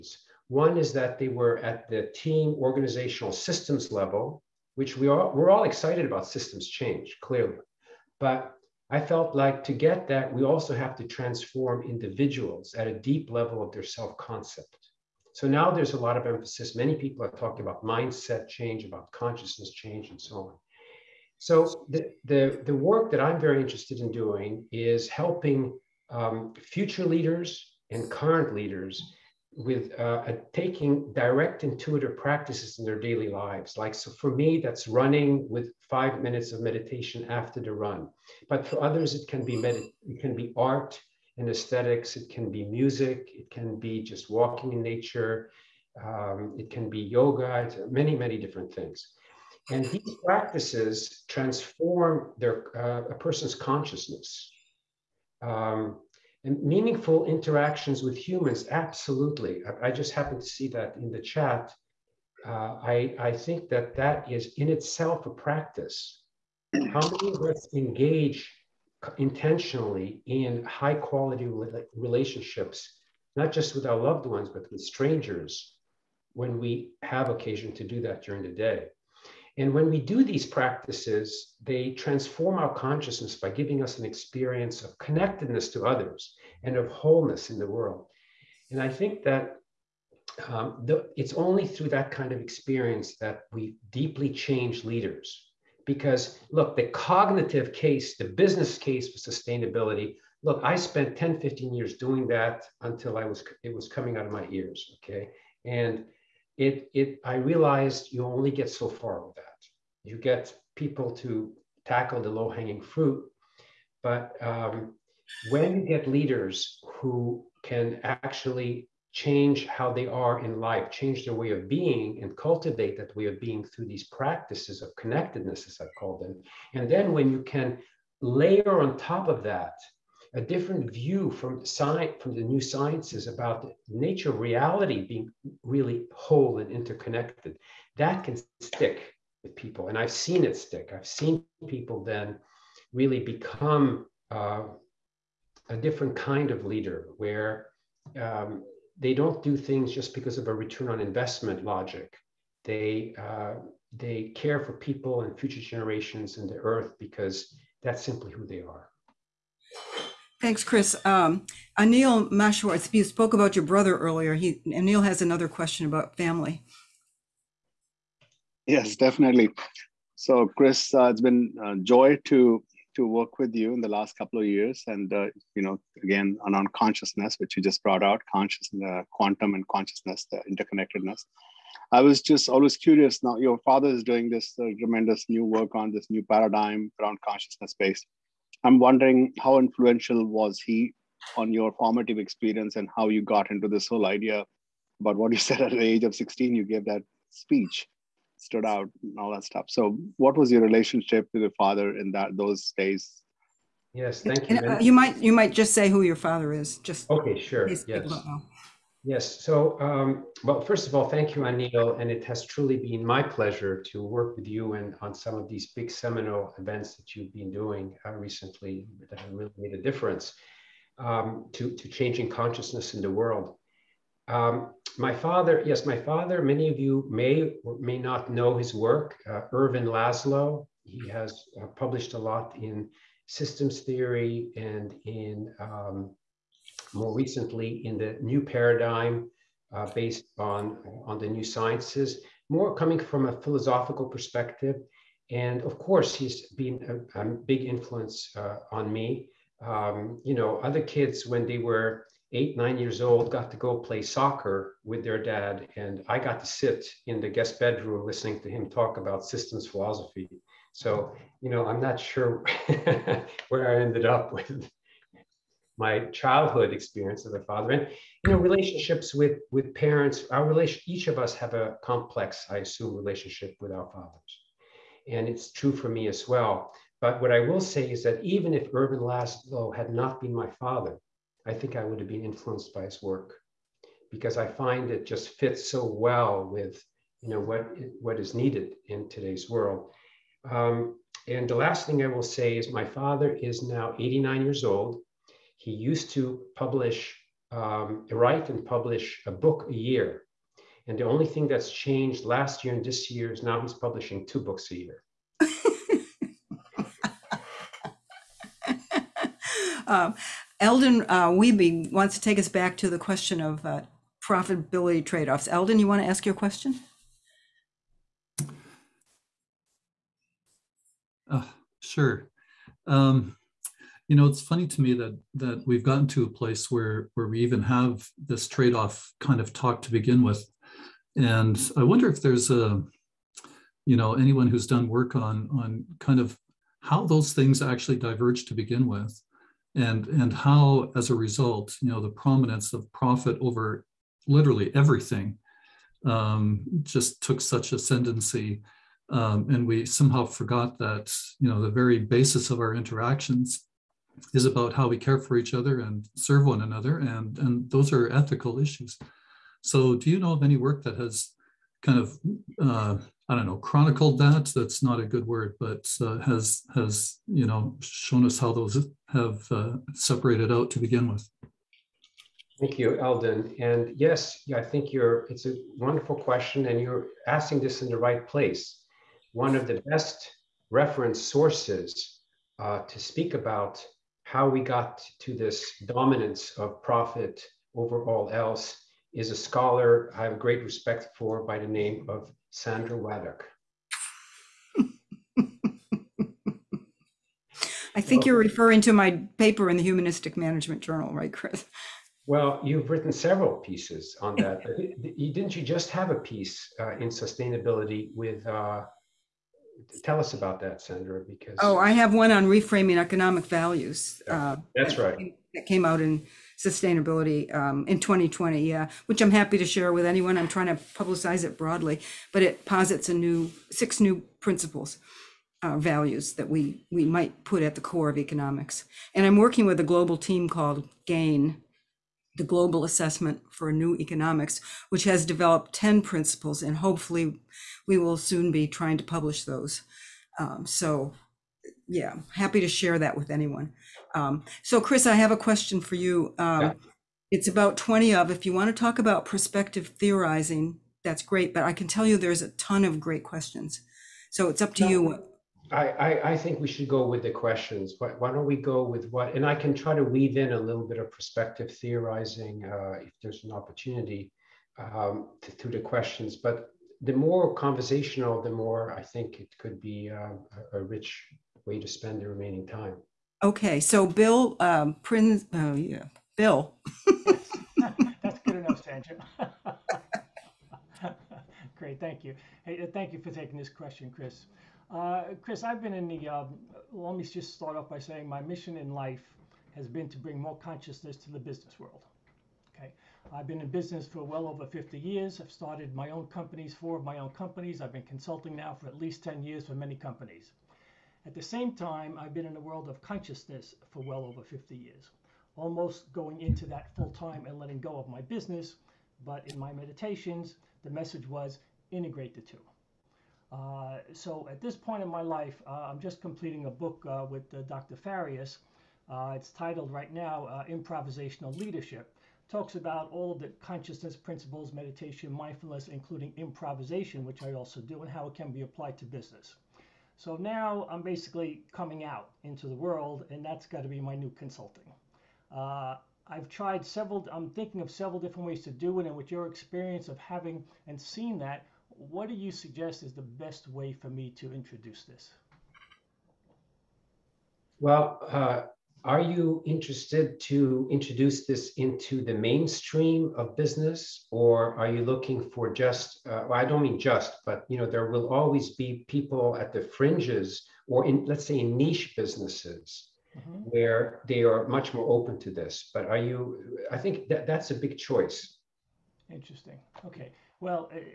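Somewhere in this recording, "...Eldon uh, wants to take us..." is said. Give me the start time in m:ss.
5:10.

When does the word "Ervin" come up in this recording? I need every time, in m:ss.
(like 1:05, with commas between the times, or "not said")
3:49, 4:38.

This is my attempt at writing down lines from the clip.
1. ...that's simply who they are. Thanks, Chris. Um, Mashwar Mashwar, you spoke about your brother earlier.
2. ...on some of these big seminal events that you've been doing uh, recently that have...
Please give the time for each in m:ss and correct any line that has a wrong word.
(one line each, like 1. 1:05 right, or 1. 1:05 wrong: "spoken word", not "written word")
1. 2:37 wrong: "Anil", not "Mashwar"
2. 3:35 right.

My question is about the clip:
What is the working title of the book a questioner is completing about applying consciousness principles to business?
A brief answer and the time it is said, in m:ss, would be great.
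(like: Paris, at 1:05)
Improvisational Leadership, at 8:40.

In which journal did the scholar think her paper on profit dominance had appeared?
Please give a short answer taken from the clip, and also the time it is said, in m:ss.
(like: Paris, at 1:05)
Humanistic Management Journal, at 6:39.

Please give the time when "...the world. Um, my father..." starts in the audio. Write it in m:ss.
3:43.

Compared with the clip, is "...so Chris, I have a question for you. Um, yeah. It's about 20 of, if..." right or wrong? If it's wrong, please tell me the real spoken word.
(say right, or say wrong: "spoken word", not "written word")
right.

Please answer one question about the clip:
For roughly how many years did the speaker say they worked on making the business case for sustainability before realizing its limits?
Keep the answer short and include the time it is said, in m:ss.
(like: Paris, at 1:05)
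10 to 15 years, at 1:41.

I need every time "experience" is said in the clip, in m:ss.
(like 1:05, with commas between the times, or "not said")
1:24, 1:32, 3:12, 4:26, 8:59.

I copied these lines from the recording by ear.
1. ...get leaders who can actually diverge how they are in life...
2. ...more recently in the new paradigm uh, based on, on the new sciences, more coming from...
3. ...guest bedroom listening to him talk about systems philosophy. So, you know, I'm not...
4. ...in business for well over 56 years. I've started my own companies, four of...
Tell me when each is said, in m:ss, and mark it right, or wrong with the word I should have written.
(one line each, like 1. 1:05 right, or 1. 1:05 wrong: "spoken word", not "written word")
1. 1:55 wrong: "change", not "diverge"
2. 3:56 right
3. 4:17 right
4. 8:13 wrong: "50", not "56".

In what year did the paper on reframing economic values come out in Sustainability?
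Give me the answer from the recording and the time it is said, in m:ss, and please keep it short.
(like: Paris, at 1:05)
2020, at 6:58.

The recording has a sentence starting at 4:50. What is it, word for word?
Um, and the last thing I will say is my father is now 89 years old.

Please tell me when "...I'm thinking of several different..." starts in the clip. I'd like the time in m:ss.
8:57.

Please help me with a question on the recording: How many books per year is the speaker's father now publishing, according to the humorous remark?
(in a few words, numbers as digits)
2.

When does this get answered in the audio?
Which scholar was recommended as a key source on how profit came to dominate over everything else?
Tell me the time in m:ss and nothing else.
6:32.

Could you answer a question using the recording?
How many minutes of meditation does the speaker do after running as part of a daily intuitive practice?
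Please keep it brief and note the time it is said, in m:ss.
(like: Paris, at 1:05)
5, at 0:35.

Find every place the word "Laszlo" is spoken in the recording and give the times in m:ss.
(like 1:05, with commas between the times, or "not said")
3:49, 4:38.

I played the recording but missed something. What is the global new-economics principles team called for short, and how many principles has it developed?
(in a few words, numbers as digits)
GAIN, 10 principles.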